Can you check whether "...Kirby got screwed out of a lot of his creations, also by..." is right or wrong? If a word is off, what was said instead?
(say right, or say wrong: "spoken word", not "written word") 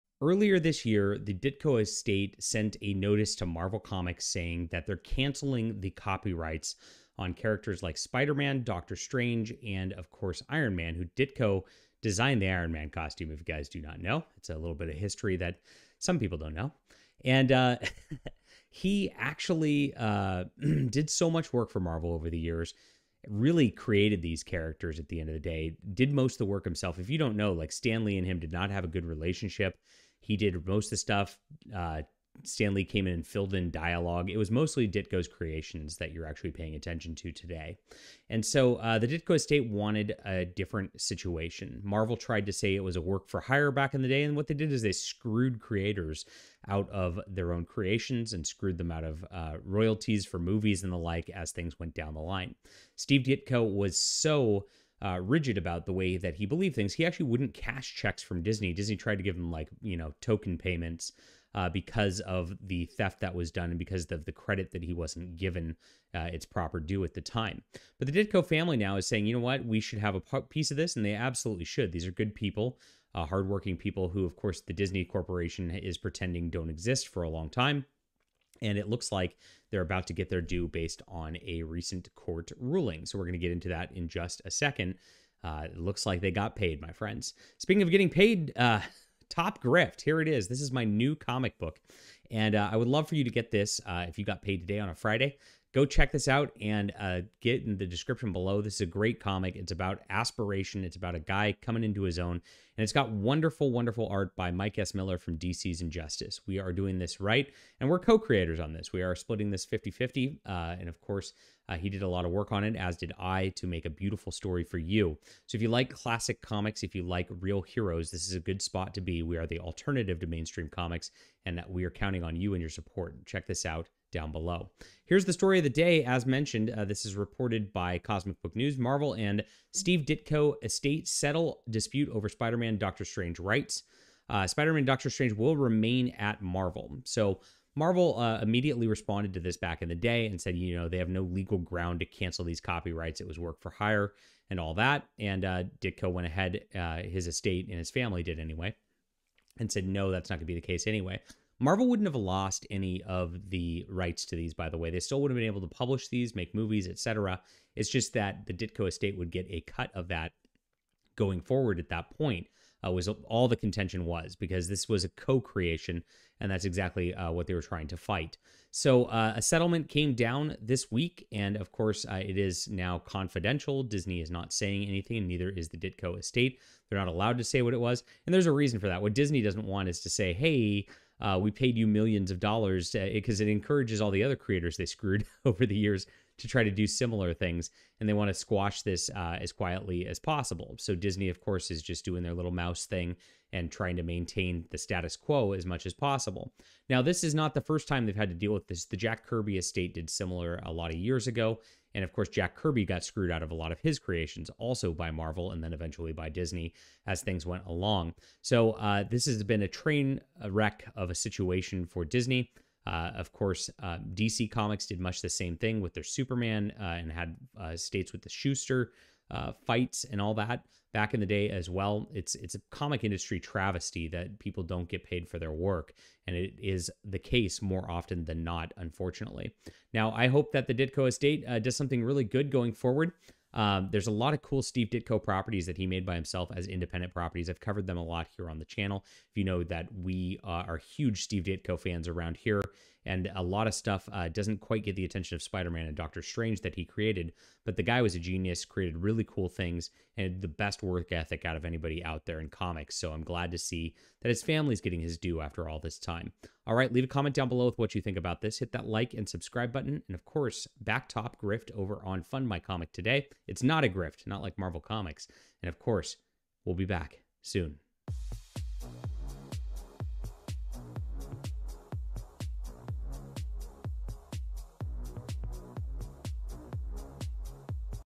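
right.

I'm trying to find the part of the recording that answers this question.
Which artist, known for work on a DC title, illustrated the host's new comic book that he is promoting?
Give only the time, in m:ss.
1:44.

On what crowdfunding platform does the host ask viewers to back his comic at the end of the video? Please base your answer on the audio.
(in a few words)
Fund My Comic.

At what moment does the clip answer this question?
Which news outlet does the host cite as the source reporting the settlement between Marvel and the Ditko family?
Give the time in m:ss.
2:07.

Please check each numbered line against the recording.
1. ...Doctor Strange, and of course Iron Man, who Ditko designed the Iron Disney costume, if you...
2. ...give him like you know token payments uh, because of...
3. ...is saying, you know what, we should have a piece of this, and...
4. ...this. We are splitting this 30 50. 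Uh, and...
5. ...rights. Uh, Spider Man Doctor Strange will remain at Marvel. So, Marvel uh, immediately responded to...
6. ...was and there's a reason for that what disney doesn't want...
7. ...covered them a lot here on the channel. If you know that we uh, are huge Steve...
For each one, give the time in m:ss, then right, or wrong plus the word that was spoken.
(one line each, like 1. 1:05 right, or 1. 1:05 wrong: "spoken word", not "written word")
1. 0:08 wrong: "Man", not "Disney"
2. 0:59 right
3. 1:08 right
4. 1:48 wrong: "50", not "30"
5. 2:13 right
6. 2:57 right
7. 3:57 right.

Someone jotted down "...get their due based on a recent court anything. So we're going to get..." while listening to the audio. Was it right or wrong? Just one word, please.
wrong.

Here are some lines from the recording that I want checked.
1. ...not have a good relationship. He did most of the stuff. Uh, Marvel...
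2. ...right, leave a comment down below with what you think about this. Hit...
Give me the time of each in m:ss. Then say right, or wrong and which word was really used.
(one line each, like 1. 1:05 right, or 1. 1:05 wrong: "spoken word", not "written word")
1. 0:28 wrong: "Stan", not "Marvel"
2. 4:16 right.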